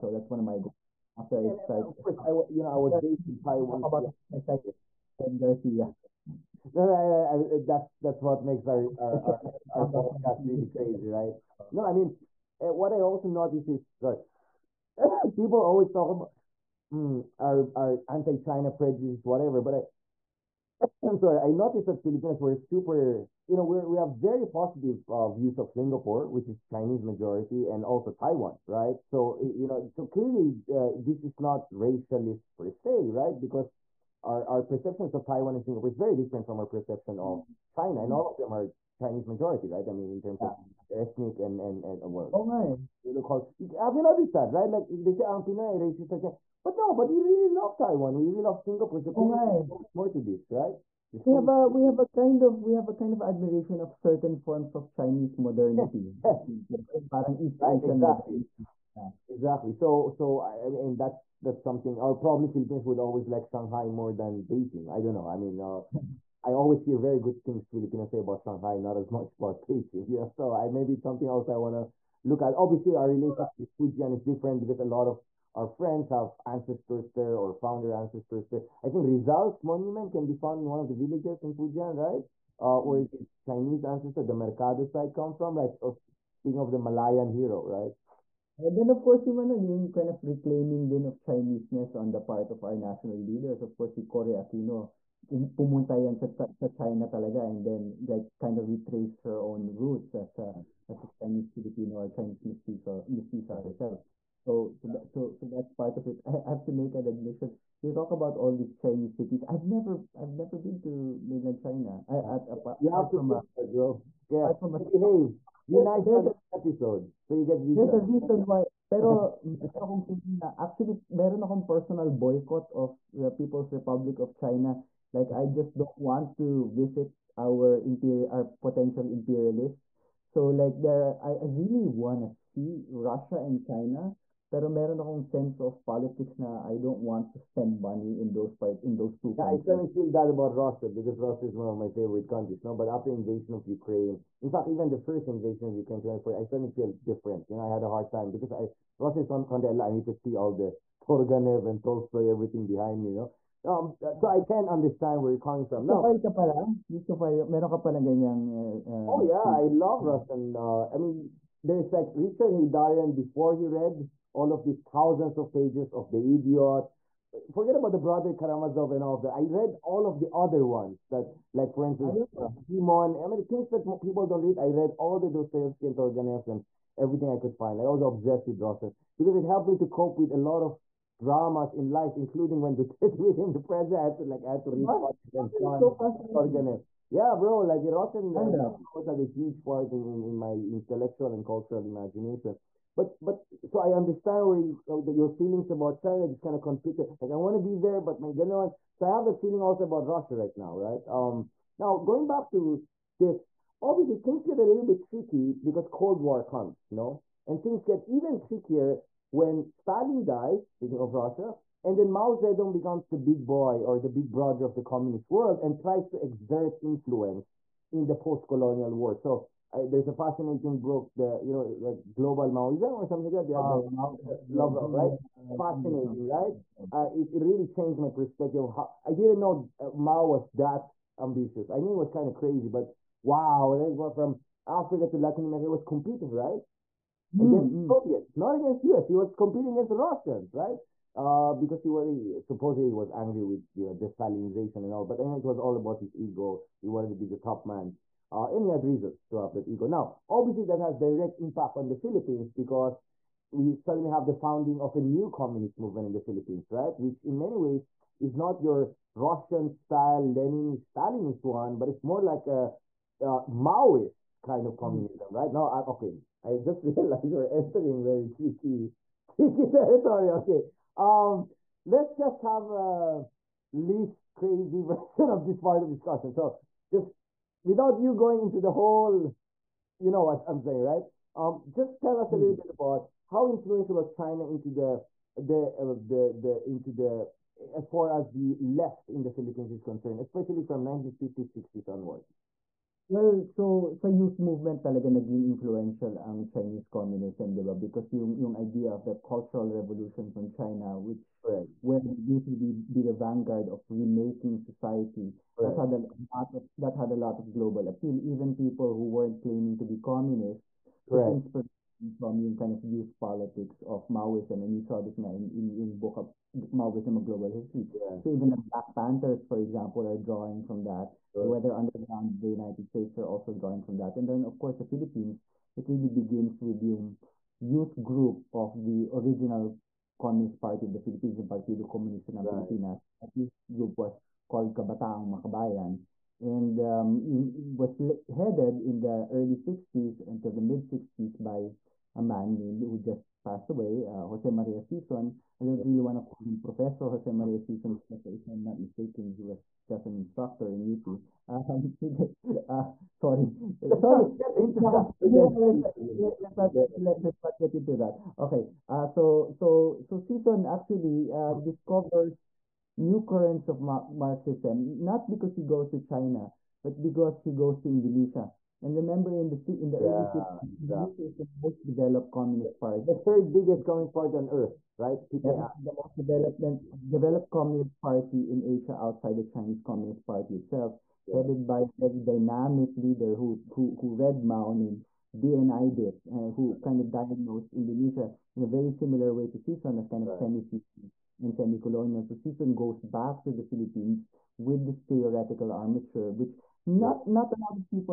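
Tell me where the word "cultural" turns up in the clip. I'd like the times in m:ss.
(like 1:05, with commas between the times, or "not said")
3:11, 4:59.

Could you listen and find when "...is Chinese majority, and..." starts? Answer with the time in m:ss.
0:26.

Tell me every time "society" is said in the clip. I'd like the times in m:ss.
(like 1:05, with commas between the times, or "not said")
5:04.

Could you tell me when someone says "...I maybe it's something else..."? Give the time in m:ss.
1:10.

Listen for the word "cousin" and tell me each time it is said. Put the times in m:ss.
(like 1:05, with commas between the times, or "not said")
not said.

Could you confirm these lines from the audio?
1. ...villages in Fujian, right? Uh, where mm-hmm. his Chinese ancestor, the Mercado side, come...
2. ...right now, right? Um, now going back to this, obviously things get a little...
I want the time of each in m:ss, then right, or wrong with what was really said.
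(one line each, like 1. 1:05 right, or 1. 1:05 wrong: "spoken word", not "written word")
1. 1:20 right
2. 3:20 right.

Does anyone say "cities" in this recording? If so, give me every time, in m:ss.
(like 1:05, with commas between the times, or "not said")
1:49.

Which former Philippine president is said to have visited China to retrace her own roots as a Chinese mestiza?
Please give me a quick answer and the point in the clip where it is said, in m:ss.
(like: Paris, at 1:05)
Cory Aquino, at 1:34.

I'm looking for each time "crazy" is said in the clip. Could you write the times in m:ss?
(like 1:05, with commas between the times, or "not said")
0:10, 3:52, 4:34.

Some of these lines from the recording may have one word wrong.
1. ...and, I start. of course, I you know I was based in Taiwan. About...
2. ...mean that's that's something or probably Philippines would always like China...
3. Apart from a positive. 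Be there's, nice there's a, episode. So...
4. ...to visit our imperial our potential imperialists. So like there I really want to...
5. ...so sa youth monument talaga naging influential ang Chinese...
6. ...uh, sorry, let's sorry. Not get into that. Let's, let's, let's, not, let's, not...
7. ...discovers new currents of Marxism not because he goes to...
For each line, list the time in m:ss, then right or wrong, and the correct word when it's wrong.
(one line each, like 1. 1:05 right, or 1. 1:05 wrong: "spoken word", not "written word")
1. 0:01 right
2. 1:00 wrong: "Shanghai", not "China"
3. 1:54 wrong: "behave", not "positive"
4. 2:06 right
5. 4:53 wrong: "movement", not "monument"
6. 5:52 right
7. 6:01 right.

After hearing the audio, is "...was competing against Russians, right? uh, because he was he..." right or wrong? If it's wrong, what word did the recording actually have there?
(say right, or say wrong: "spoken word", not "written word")
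right.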